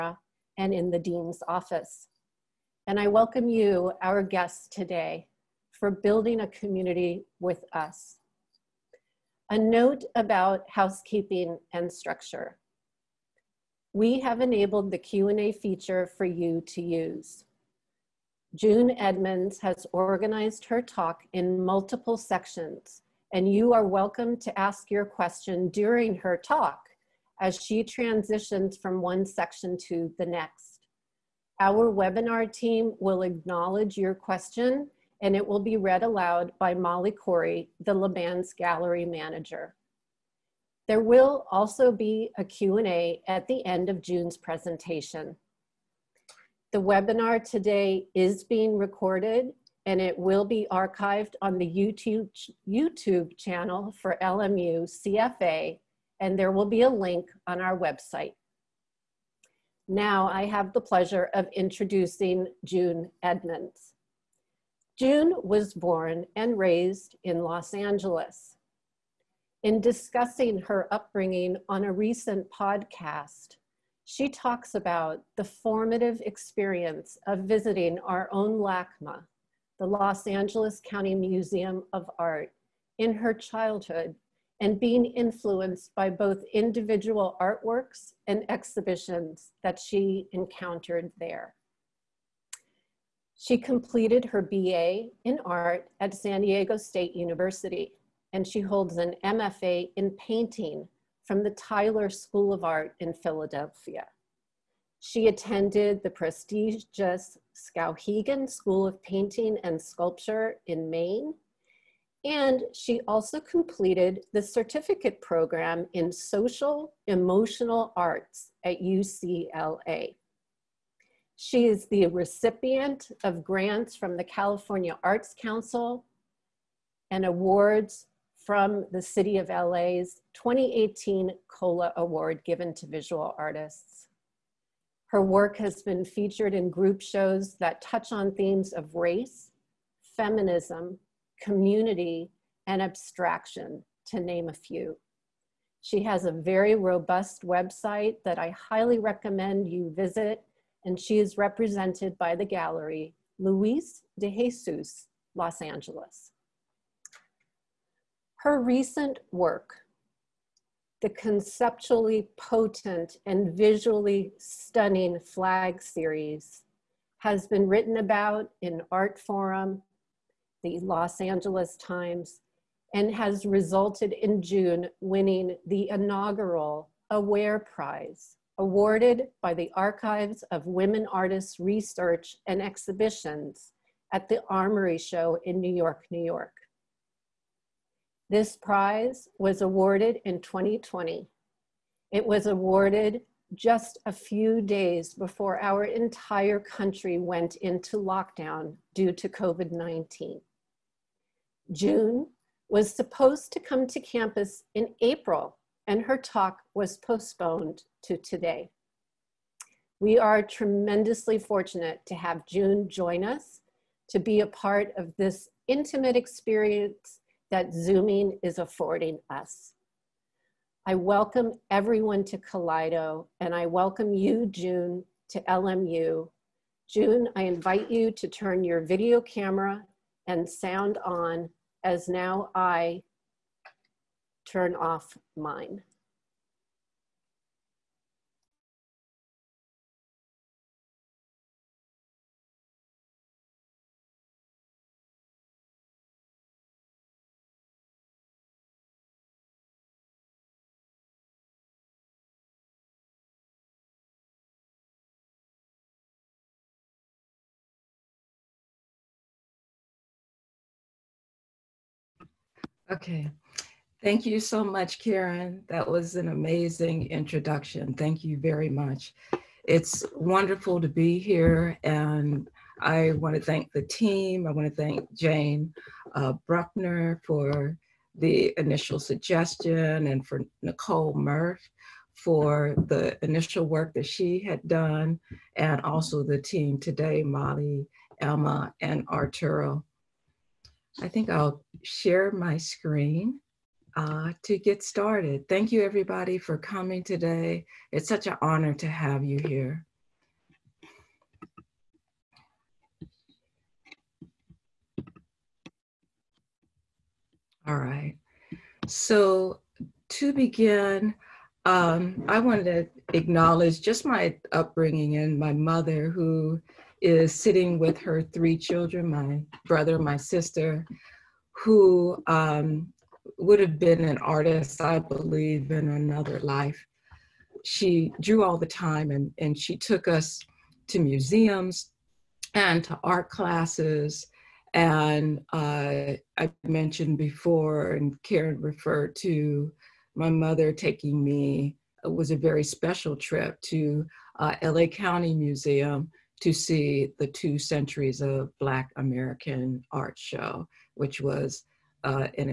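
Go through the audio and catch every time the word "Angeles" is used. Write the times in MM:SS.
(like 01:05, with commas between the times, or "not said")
01:07, 01:20, 02:35, 02:51.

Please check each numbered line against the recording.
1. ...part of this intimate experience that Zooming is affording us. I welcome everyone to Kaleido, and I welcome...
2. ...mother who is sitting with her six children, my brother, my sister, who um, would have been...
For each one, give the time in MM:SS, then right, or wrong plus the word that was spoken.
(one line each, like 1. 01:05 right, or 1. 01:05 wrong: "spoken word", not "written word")
1. 03:34 right
2. 05:15 wrong: "three", not "six".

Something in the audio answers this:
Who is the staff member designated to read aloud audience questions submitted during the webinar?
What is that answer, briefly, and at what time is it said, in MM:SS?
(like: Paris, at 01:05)
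Molly Corey, at 00:36.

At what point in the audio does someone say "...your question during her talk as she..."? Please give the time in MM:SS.
00:24.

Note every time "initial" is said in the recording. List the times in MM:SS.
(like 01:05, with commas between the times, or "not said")
04:38, 04:43.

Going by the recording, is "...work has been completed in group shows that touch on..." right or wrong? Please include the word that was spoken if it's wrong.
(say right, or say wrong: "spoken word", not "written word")
wrong: "featured", not "completed".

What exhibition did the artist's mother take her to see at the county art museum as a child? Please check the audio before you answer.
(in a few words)
Two Centuries of Black American Art.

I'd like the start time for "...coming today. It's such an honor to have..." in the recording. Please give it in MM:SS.
04:56.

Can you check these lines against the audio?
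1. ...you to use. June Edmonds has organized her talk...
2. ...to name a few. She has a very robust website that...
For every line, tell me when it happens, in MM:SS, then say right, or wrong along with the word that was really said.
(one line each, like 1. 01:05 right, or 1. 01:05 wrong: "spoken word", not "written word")
1. 00:16 right
2. 02:24 right.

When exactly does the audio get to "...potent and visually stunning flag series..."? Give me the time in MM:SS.
02:42.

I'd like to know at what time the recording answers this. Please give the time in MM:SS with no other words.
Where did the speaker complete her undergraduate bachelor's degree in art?
01:36.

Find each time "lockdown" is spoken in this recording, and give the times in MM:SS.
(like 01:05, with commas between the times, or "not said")
03:17.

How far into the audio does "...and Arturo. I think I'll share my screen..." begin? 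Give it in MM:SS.
04:48.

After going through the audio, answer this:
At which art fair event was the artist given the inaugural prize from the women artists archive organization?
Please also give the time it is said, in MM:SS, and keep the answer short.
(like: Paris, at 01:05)
the Armory Show, at 03:04.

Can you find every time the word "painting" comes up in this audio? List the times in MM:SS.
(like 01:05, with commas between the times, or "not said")
01:40, 01:49.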